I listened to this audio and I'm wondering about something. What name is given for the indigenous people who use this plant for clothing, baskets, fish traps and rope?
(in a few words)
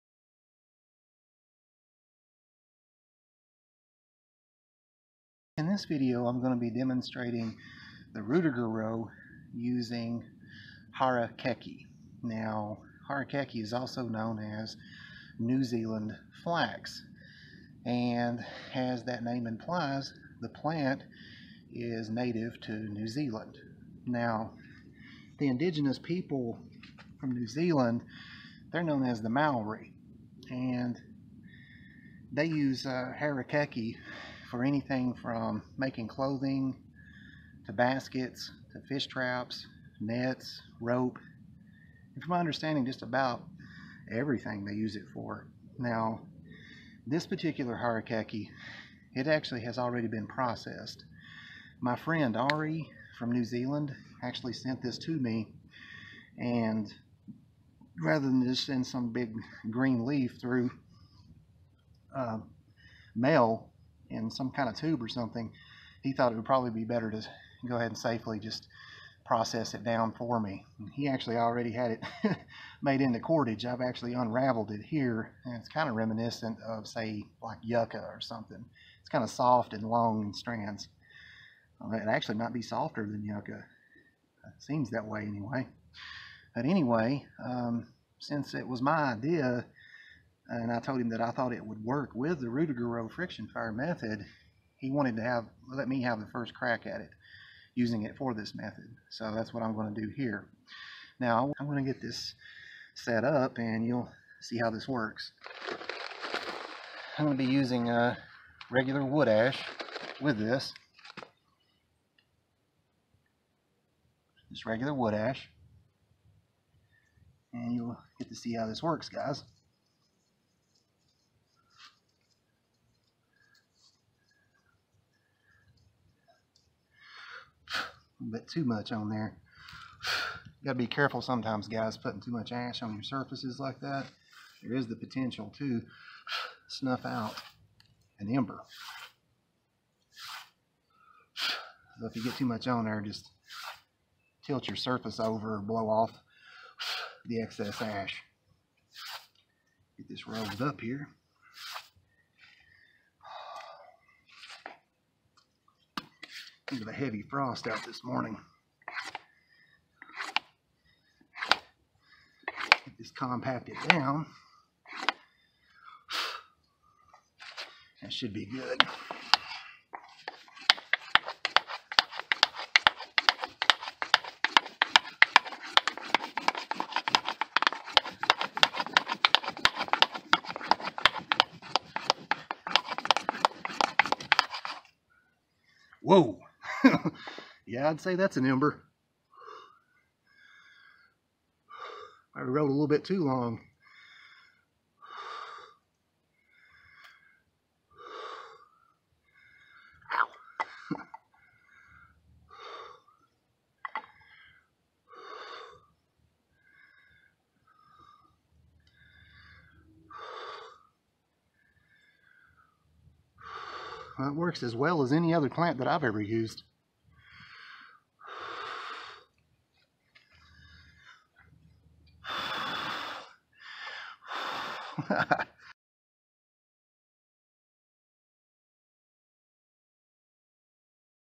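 Maori.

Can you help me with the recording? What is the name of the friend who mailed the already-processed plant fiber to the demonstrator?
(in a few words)
Ari.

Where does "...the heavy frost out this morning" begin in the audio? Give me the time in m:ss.
2:36.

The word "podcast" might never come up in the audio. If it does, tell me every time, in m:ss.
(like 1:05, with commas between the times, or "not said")
not said.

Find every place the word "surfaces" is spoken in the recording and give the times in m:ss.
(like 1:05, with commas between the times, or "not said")
2:13, 2:24.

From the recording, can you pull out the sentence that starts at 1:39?
So that's what I'm going to do here.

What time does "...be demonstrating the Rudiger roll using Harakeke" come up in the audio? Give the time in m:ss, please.
0:06.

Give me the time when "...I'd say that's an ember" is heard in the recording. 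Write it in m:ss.
3:07.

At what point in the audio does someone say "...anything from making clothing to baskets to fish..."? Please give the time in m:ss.
0:34.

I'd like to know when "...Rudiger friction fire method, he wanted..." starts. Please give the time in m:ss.
1:32.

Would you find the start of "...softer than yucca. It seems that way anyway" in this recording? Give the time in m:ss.
1:22.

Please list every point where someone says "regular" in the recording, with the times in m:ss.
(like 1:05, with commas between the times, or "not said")
1:48, 1:54.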